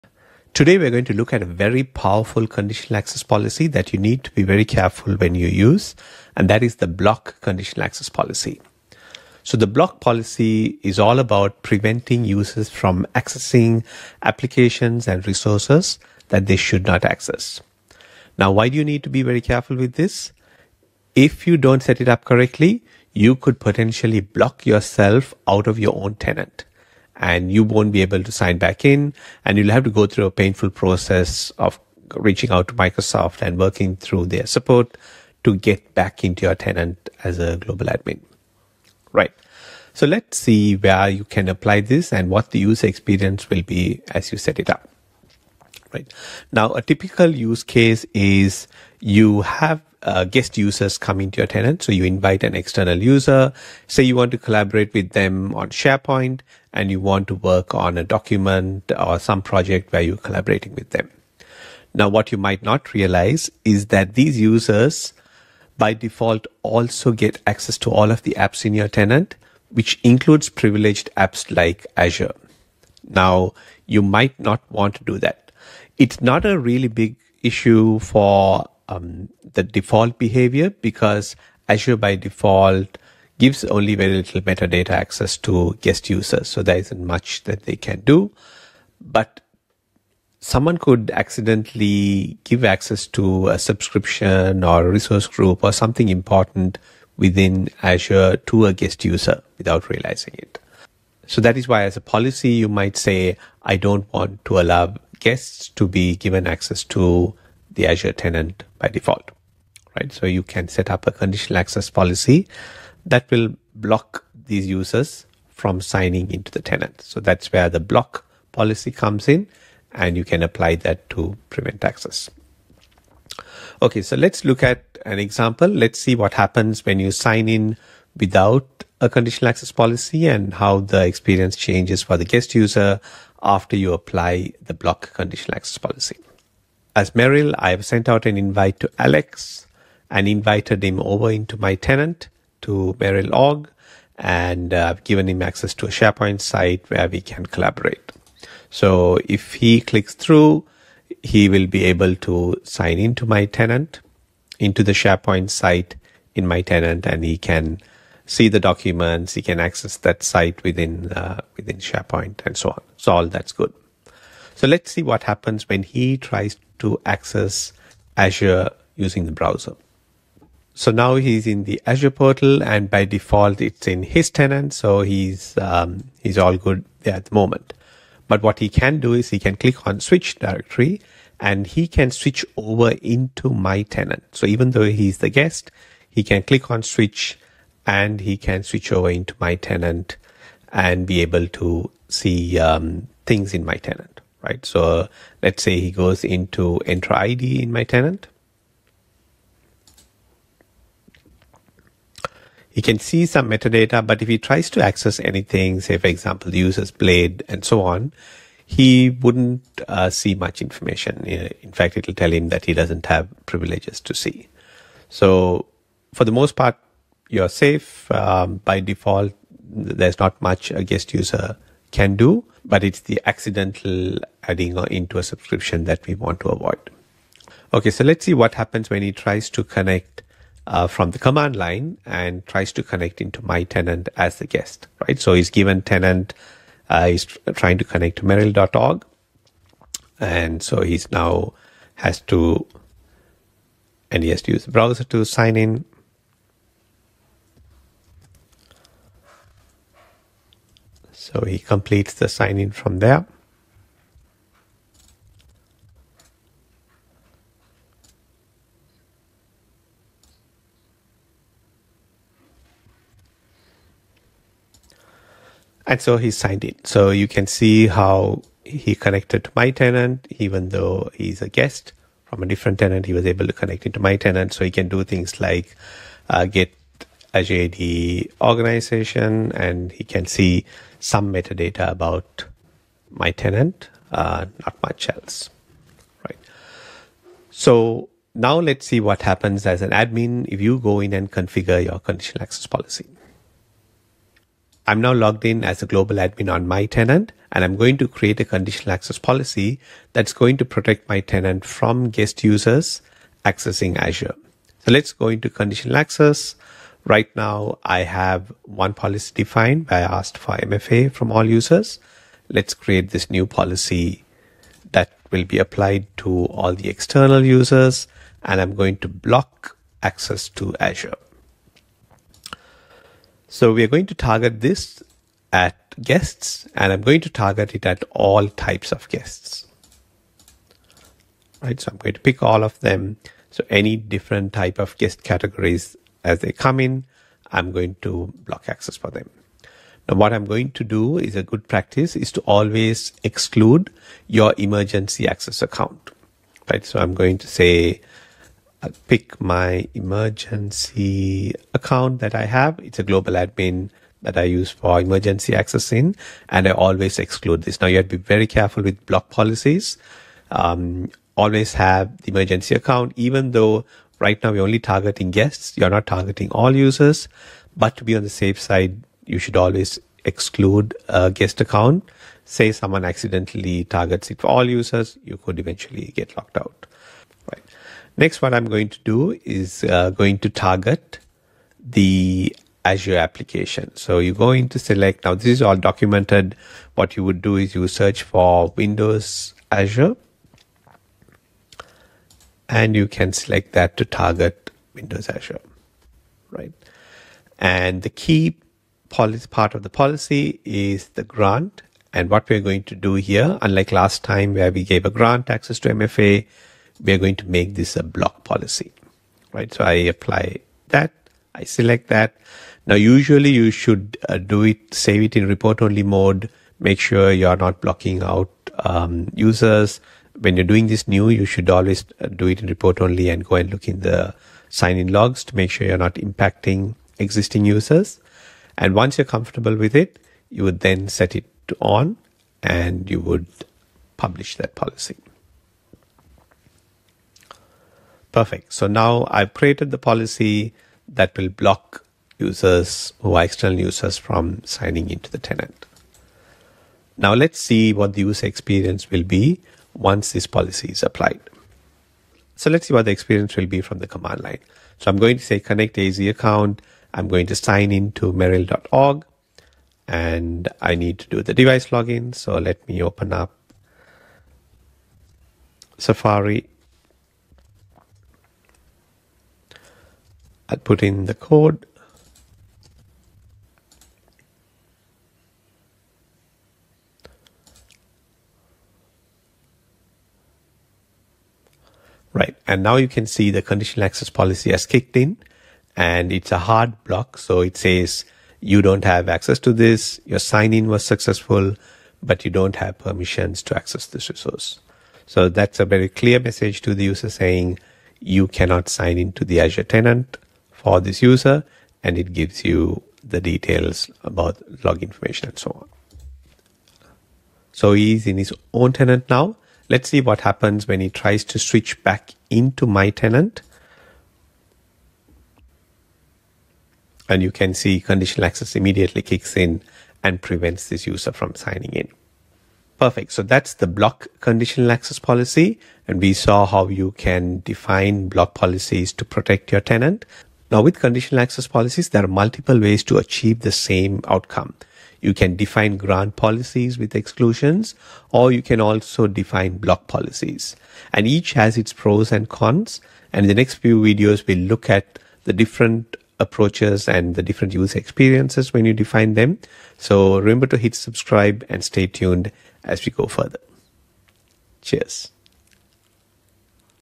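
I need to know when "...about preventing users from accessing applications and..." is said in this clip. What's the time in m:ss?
0:11.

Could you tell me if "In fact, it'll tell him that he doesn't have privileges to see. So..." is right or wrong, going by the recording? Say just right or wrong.
right.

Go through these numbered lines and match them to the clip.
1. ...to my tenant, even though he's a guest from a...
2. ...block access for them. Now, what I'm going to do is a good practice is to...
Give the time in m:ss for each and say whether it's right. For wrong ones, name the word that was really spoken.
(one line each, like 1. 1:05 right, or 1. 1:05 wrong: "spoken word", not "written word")
1. 4:29 right
2. 5:38 right.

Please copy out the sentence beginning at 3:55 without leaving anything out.
So he's given tenant, uh, he's trying to connect to Merill.org.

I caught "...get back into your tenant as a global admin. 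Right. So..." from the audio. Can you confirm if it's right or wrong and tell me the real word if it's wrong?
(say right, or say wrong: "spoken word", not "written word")
right.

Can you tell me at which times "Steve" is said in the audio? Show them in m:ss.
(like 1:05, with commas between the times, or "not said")
not said.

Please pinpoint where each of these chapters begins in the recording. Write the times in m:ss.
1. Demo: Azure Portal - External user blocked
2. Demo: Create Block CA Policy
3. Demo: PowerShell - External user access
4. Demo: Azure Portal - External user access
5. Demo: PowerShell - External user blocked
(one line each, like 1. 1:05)
1. 8:28
2. 4:48
3. 3:47
4. 2:03
5. 7:33.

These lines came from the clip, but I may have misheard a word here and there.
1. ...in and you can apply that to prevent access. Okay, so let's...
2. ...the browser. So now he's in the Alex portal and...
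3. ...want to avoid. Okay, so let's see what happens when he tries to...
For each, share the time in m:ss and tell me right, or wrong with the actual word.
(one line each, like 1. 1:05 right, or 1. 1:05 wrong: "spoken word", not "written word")
1. 1:59 right
2. 2:49 wrong: "Azure", not "Alex"
3. 3:46 right.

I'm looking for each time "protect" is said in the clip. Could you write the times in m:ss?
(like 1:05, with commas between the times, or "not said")
5:00, 8:49.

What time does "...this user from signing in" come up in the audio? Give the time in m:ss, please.
8:40.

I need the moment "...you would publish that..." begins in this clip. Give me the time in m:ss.
7:13.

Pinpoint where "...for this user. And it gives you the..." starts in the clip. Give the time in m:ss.
8:20.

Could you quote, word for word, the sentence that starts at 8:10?
Your sign in was successful, but you don't have permissions to access this resource.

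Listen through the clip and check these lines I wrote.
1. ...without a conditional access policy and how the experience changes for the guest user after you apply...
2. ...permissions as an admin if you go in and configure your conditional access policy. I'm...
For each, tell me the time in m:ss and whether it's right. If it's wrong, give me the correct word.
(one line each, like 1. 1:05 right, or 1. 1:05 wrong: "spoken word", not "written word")
1. 2:08 right
2. 4:49 wrong: "happens", not "permissions".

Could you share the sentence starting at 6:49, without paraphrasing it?
So I apply that, I select that.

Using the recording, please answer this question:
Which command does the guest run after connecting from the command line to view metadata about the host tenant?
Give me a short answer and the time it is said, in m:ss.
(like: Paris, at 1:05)
get AD organization, at 4:36.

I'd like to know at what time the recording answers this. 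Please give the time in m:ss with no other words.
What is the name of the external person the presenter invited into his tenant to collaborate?
2:18.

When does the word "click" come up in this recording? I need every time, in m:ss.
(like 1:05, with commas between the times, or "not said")
2:29, 2:59, 3:06.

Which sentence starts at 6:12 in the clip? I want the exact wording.
Say someone accidentally targets it for all users, you could eventually get locked out.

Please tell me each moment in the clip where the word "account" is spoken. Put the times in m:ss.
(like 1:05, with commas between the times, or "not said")
5:45, 5:51, 6:02, 6:11, 7:36.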